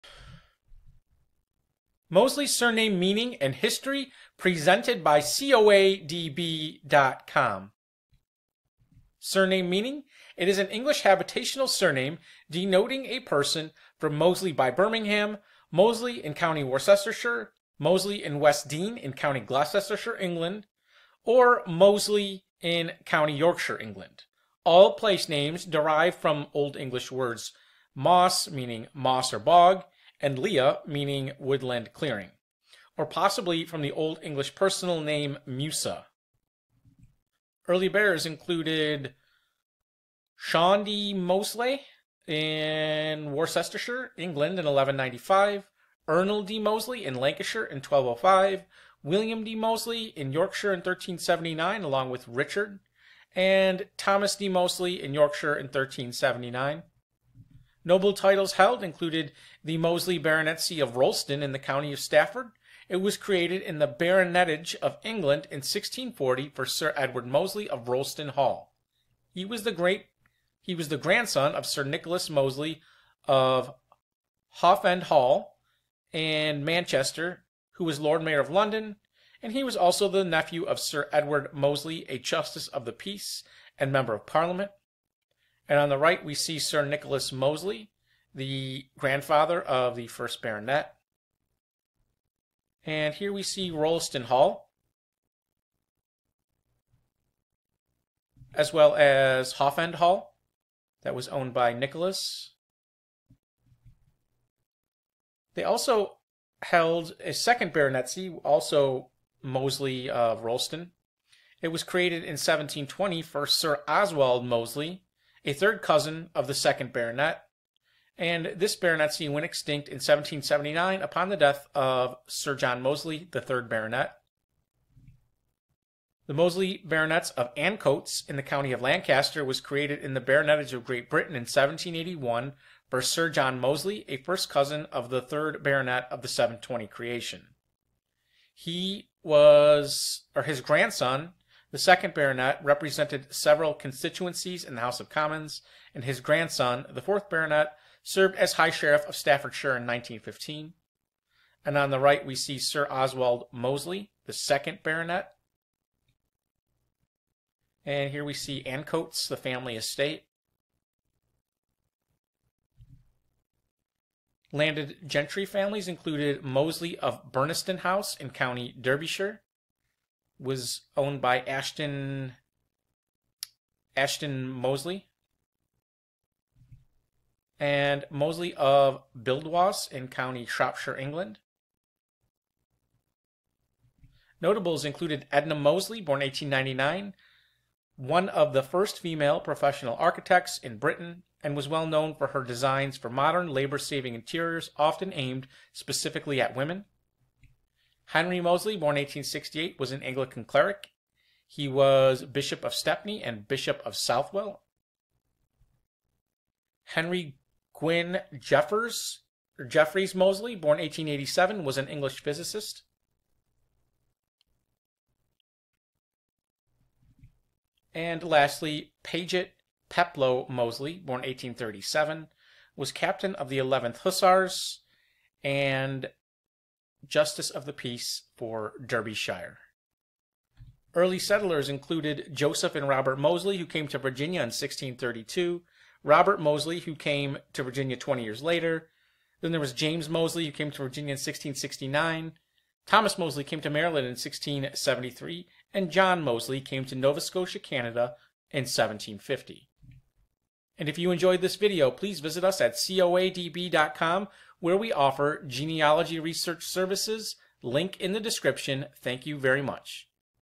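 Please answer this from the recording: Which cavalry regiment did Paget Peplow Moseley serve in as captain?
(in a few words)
11th Hussars.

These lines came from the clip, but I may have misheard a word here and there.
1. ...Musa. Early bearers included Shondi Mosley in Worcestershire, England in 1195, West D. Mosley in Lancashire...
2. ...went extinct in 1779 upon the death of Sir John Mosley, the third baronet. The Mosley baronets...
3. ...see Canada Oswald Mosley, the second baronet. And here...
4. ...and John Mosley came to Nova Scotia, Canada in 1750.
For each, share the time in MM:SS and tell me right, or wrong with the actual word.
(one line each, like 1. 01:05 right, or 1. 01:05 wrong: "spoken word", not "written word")
1. 00:35 wrong: "Ernold", not "West"
2. 01:59 right
3. 02:32 wrong: "Sir", not "Canada"
4. 04:05 right.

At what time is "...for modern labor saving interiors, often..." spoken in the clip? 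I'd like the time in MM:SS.
03:12.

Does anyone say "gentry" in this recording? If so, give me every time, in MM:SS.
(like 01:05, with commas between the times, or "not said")
02:45.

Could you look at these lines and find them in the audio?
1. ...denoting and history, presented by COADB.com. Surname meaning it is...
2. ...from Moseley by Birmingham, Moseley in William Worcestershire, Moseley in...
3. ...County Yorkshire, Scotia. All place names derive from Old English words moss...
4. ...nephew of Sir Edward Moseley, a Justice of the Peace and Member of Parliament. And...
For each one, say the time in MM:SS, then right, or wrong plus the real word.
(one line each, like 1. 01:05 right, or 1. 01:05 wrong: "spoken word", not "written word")
1. 00:02 wrong: "meaning", not "denoting"
2. 00:13 wrong: "County", not "William"
3. 00:23 wrong: "England", not "Scotia"
4. 01:20 right.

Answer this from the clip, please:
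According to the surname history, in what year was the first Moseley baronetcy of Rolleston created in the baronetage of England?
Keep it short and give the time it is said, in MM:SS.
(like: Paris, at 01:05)
1640, at 01:05.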